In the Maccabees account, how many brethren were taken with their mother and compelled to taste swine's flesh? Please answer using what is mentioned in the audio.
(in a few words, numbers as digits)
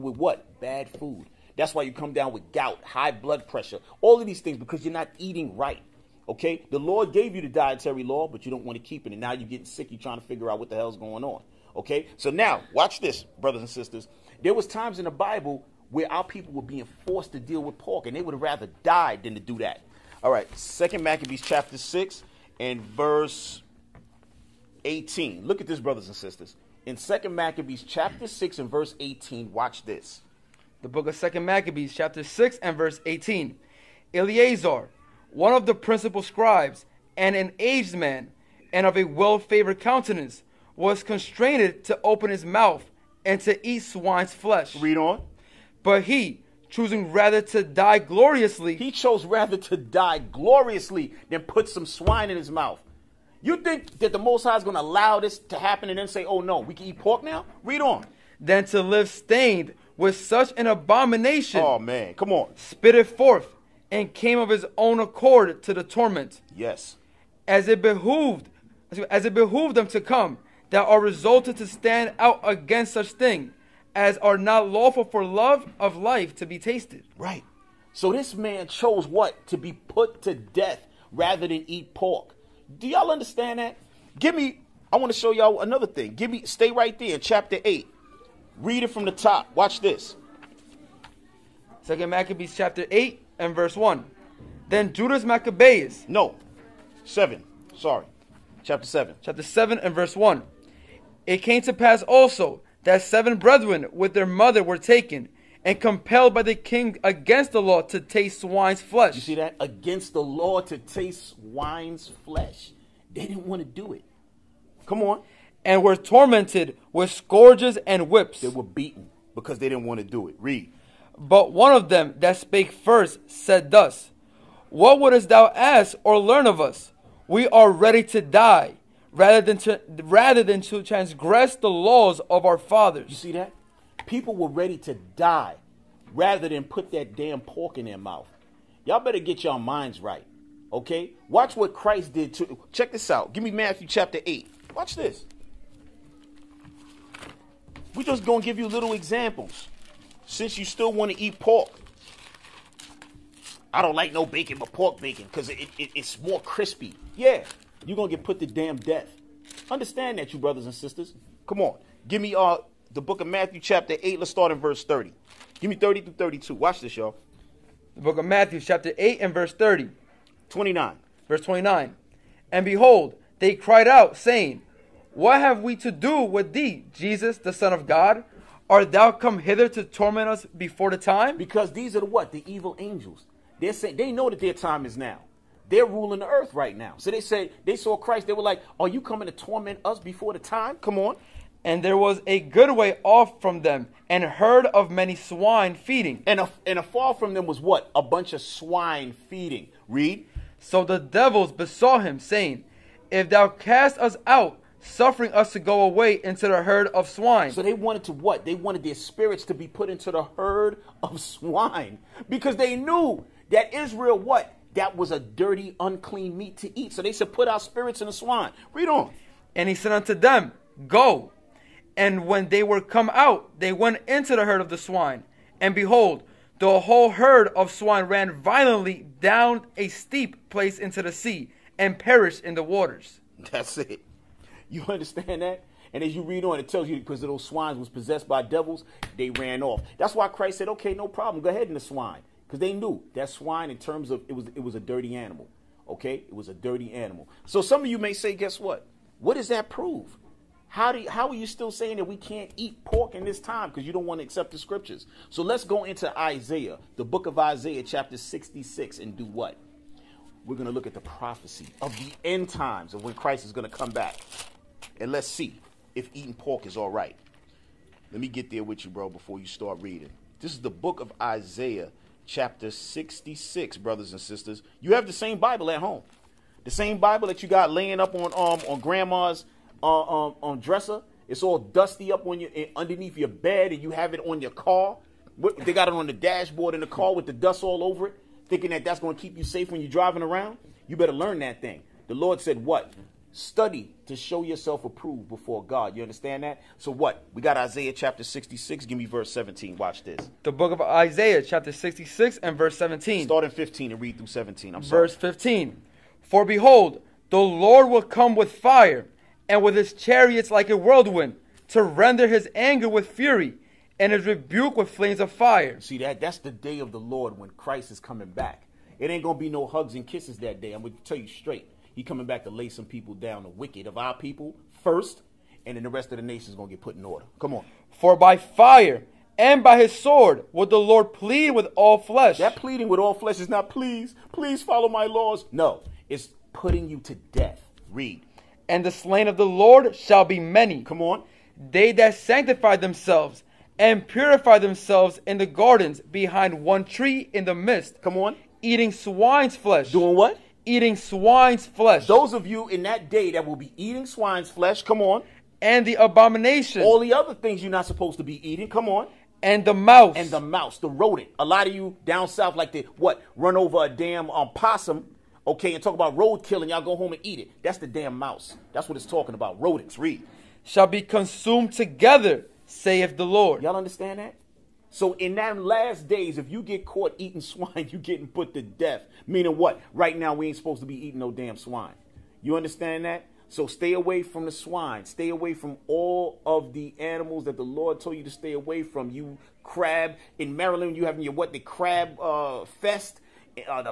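7.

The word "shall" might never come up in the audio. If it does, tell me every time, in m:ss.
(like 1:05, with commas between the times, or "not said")
5:39, 6:10.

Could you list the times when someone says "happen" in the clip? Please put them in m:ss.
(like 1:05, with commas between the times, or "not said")
0:55.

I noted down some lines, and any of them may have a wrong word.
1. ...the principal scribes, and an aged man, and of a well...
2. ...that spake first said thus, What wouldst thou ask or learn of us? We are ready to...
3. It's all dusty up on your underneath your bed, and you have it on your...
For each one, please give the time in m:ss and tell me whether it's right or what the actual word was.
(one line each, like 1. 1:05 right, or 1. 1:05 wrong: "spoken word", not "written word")
1. 0:35 right
2. 2:02 right
3. 4:41 right.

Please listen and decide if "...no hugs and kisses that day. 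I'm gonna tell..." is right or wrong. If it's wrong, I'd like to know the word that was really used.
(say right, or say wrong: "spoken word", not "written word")
right.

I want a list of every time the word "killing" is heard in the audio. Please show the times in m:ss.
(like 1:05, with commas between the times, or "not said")
6:06.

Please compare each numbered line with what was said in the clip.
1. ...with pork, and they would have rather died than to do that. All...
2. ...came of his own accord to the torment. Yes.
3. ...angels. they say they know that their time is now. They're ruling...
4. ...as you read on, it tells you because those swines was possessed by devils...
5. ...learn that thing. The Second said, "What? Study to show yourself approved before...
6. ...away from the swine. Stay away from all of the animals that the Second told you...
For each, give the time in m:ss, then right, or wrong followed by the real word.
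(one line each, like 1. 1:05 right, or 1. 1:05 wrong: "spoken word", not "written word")
1. 0:17 right
2. 1:04 right
3. 3:02 right
4. 3:56 right
5. 4:51 wrong: "Lord", not "Second"
6. 6:23 wrong: "Lord", not "Second".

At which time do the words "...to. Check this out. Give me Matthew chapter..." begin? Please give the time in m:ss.
2:22.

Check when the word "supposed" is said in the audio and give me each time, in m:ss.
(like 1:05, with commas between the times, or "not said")
5:57, 6:20.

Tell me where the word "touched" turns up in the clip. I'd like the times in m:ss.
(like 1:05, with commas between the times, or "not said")
not said.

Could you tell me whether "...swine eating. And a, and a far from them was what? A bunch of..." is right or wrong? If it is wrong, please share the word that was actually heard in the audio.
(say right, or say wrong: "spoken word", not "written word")
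wrong: "feeding", not "eating".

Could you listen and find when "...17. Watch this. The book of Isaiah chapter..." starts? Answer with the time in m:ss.
4:59.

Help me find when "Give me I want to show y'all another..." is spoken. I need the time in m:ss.
1:24.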